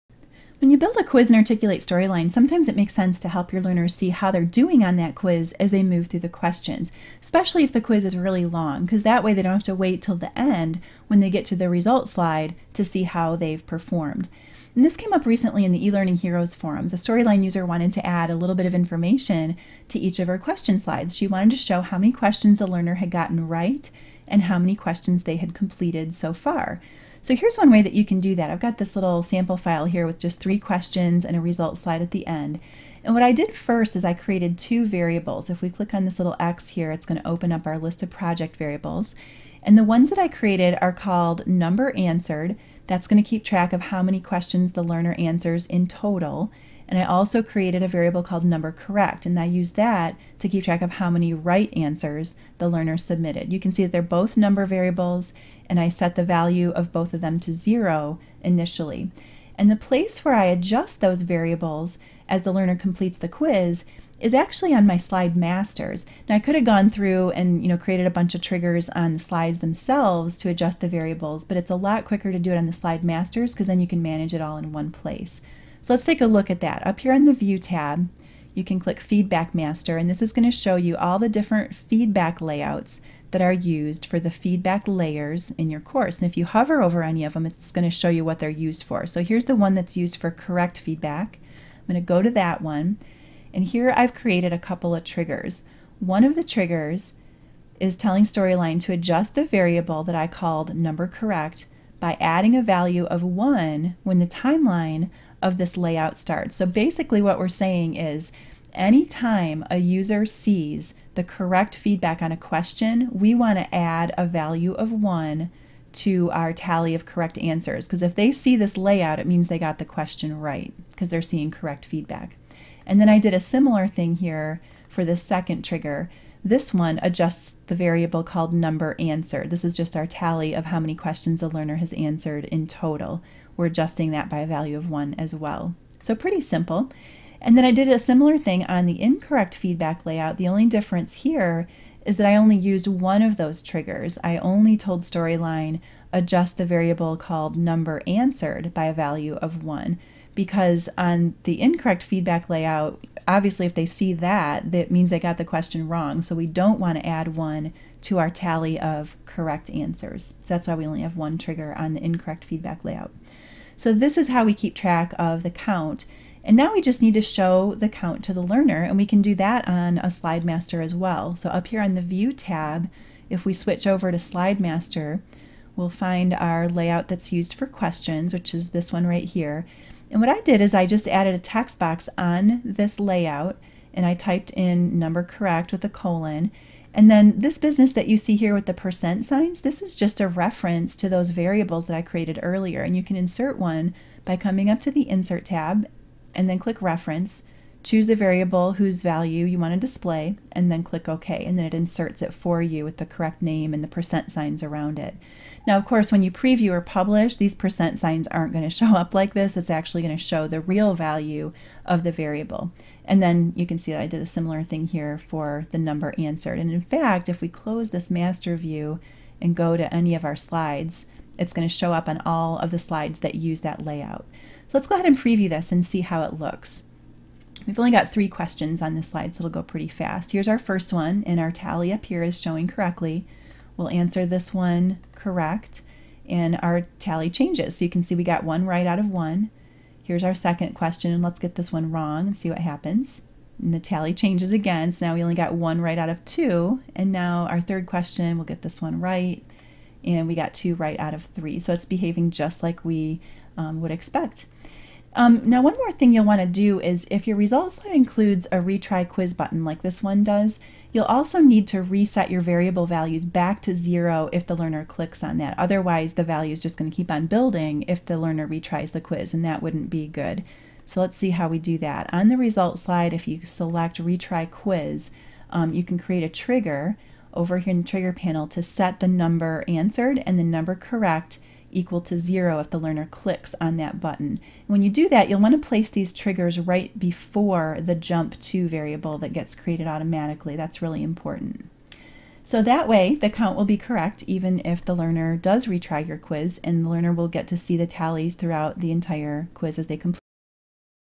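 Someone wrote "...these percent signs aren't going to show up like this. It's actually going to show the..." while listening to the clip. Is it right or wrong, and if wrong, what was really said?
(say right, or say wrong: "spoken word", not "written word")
right.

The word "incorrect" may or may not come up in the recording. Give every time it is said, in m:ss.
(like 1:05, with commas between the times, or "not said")
2:19, 2:31, 2:42.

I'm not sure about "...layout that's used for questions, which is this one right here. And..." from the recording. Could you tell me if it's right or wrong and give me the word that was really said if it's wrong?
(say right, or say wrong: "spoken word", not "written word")
right.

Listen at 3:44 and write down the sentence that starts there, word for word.
So let's go ahead and preview this and see how it looks.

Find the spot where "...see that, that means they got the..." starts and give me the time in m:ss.
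2:33.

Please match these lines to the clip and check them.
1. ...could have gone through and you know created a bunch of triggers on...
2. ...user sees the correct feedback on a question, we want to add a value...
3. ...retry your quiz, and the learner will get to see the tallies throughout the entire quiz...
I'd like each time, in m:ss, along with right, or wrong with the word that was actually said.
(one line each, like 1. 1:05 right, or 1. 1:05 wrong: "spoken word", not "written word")
1. 1:06 right
2. 1:49 right
3. 4:55 right.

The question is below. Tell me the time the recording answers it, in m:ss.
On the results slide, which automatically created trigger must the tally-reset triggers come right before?
4:47.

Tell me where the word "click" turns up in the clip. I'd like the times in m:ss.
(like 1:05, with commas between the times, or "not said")
0:35, 1:18, 3:16, 3:20, 4:24, 4:43.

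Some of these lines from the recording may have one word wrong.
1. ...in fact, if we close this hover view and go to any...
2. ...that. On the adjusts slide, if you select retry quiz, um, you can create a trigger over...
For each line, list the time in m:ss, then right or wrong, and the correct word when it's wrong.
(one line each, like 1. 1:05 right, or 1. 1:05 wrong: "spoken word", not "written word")
1. 3:36 wrong: "master", not "hover"
2. 4:31 wrong: "results", not "adjusts".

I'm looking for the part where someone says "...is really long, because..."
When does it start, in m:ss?
0:08.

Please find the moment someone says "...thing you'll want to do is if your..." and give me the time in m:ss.
4:15.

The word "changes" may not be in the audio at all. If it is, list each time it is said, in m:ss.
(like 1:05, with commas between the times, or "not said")
3:57, 4:04.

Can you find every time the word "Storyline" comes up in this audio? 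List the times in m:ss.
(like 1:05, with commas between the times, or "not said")
0:01, 0:16, 1:38, 2:25.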